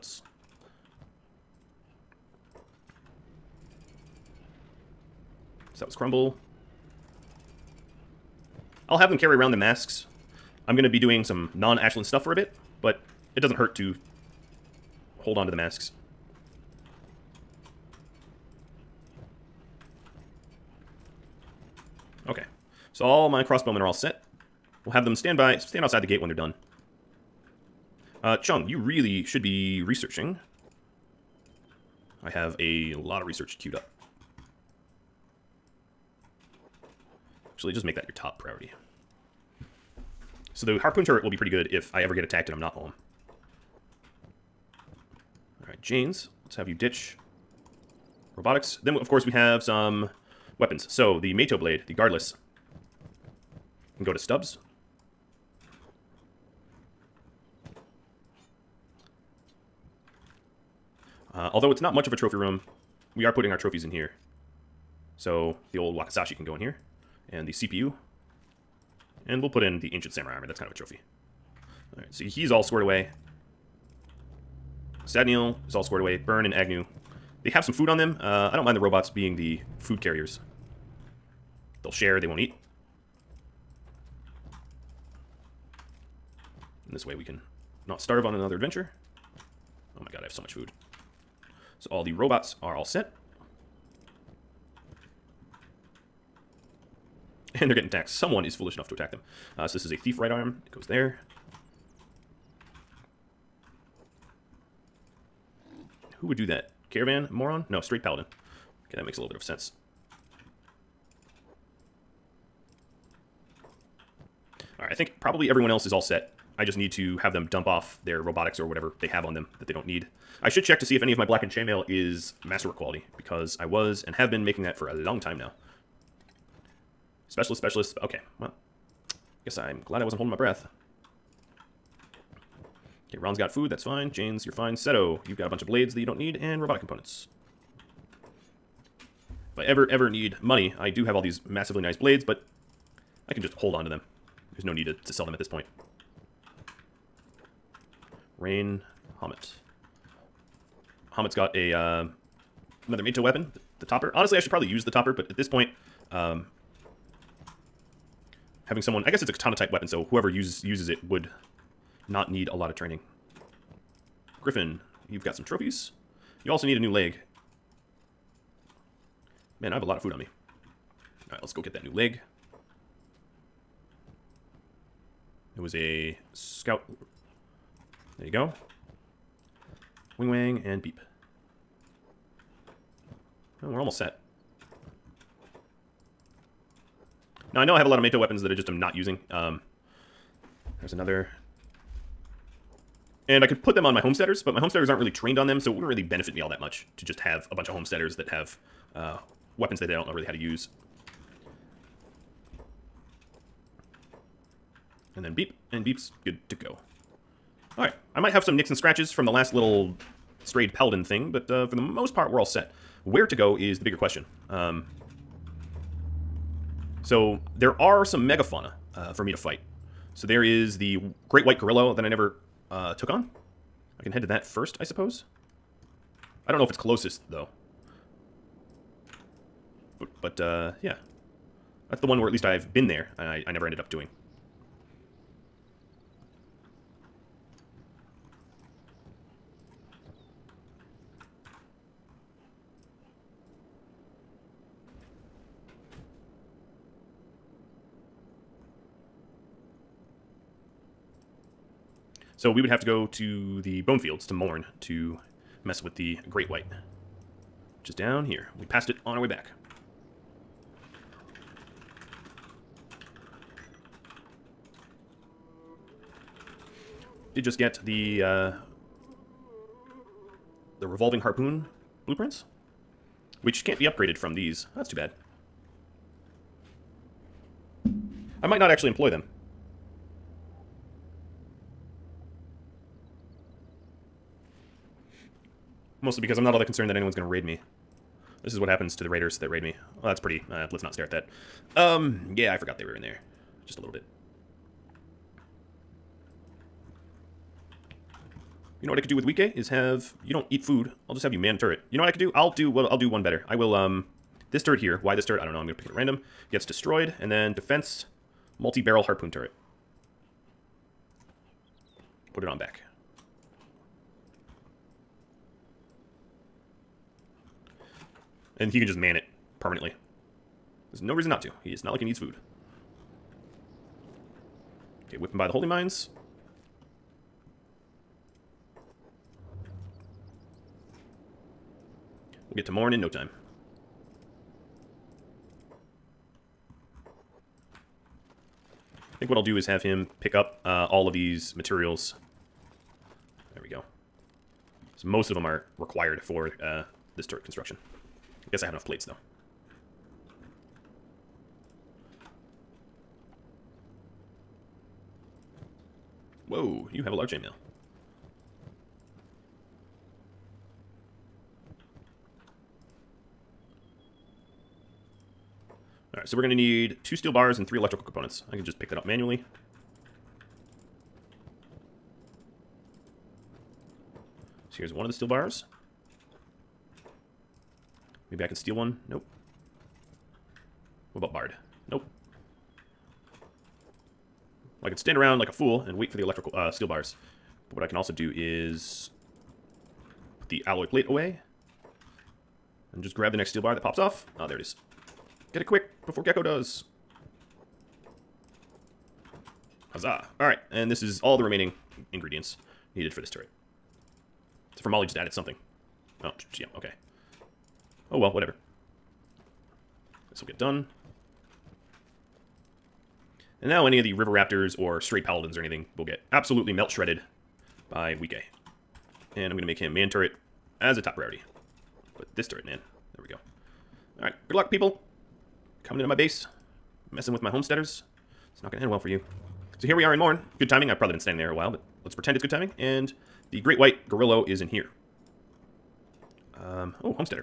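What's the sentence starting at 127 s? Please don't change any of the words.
Specialist, specialist, okay, well, guess I'm glad I wasn't holding my breath.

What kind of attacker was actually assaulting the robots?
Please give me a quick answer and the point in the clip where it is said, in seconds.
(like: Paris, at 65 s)
Straight paladin, at 107 s.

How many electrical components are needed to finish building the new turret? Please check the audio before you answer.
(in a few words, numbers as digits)
3.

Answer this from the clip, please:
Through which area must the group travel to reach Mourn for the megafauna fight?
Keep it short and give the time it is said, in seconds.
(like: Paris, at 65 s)
Bonefields, at 253 s.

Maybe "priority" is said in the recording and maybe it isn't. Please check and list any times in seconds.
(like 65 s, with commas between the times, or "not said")
38 s, 421 s.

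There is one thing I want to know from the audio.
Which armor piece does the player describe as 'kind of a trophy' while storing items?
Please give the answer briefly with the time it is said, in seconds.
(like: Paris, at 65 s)
Ancient Samurai Armor, at 69 s.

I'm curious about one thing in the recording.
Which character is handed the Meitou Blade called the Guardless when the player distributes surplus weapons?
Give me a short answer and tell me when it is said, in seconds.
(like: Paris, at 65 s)
Stubbs, at 54 s.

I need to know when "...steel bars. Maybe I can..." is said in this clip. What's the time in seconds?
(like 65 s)
375 s.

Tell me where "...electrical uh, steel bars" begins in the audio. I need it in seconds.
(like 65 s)
386 s.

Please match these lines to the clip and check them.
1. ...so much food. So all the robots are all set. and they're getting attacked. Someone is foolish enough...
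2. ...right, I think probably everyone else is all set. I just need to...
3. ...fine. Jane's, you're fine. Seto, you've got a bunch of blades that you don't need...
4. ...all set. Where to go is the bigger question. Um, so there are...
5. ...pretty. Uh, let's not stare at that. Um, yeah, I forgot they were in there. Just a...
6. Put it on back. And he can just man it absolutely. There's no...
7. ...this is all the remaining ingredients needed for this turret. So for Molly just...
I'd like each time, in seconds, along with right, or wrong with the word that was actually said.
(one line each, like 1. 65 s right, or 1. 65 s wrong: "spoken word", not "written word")
1. 90 s right
2. 114 s right
3. 133 s right
4. 212 s right
5. 290 s right
6. 312 s wrong: "permanently", not "absolutely"
7. 400 s right.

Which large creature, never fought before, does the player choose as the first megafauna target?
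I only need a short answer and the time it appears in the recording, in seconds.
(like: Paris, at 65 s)
Great white gorilla, at 221 s.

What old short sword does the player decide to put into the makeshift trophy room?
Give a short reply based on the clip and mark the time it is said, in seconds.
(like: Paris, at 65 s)
Wakizashi, at 65 s.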